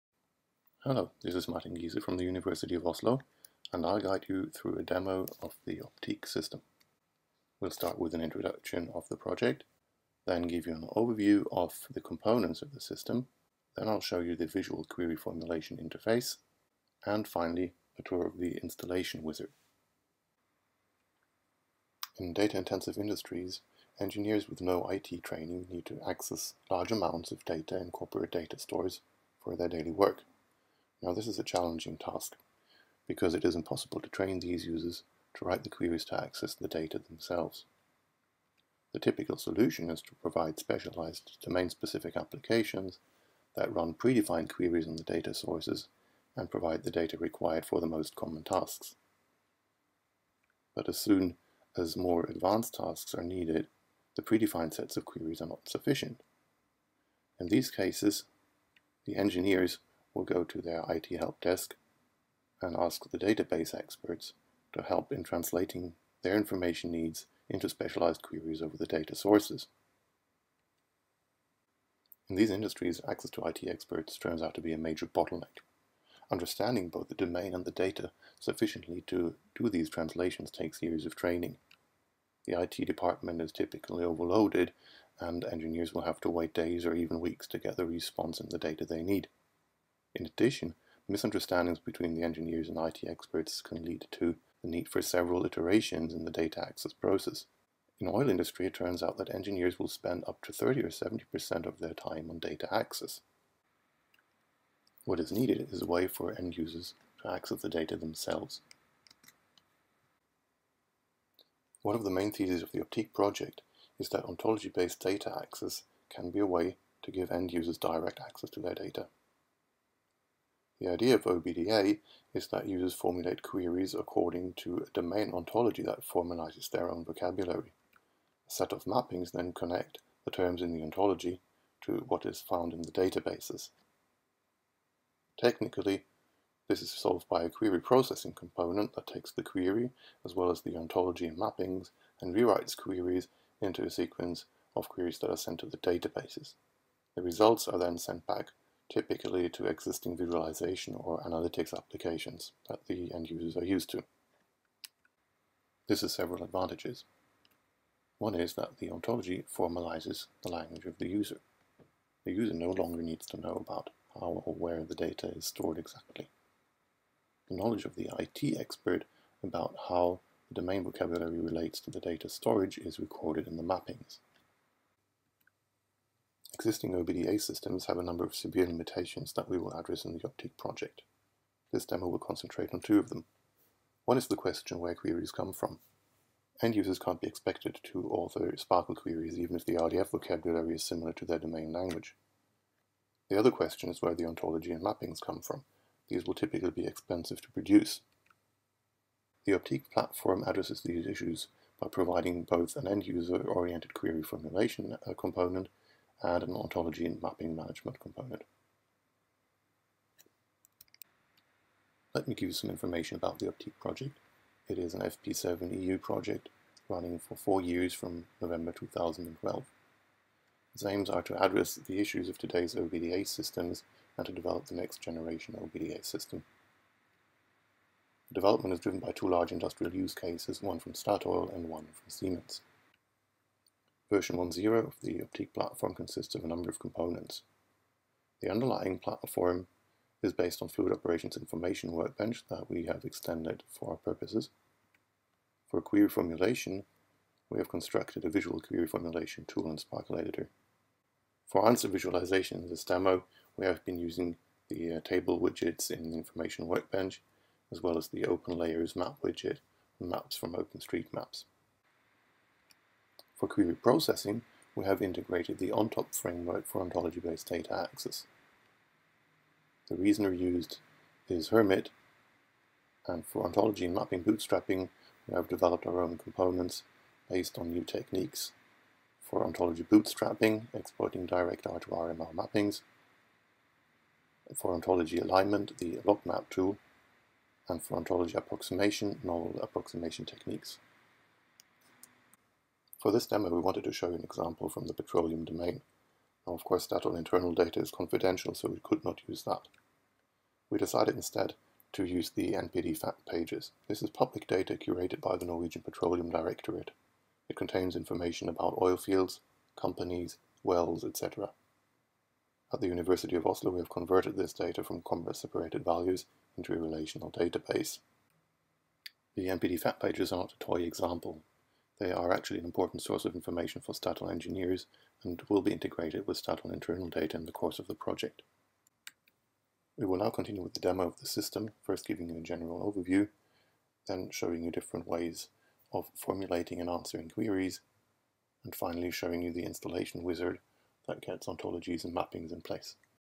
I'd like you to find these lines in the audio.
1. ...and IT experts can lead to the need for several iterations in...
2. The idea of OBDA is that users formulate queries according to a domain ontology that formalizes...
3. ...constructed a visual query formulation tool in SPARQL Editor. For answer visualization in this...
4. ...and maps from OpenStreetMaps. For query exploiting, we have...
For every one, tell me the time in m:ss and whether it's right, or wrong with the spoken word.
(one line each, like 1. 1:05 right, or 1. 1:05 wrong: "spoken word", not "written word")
1. 1:32 right
2. 2:00 right
3. 4:07 right
4. 4:20 wrong: "processing", not "exploiting".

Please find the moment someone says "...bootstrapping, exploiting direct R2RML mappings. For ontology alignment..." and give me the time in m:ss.
4:39.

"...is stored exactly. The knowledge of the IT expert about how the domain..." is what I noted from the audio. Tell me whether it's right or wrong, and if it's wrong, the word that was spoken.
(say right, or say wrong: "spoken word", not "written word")
right.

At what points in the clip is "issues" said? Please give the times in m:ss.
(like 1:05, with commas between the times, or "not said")
3:21, 3:41.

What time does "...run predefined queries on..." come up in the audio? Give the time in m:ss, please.
0:43.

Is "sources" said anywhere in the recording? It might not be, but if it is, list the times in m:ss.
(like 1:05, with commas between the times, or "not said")
0:45, 1:09, 5:23.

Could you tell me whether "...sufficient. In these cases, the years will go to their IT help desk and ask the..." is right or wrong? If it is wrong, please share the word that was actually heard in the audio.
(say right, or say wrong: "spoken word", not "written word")
wrong: "engineers", not "years".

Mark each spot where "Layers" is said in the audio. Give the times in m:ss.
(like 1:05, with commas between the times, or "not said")
4:18.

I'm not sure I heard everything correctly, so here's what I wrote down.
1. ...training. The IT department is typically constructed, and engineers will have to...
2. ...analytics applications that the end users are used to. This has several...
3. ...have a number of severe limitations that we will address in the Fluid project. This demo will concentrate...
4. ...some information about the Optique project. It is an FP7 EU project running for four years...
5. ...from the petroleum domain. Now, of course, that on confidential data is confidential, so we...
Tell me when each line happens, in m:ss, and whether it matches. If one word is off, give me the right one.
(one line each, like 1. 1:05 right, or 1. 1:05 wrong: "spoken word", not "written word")
1. 1:21 wrong: "overloaded", not "constructed"
2. 2:31 right
3. 2:57 wrong: "Optique", not "Fluid"
4. 3:32 right
5. 4:54 wrong: "internal", not "confidential".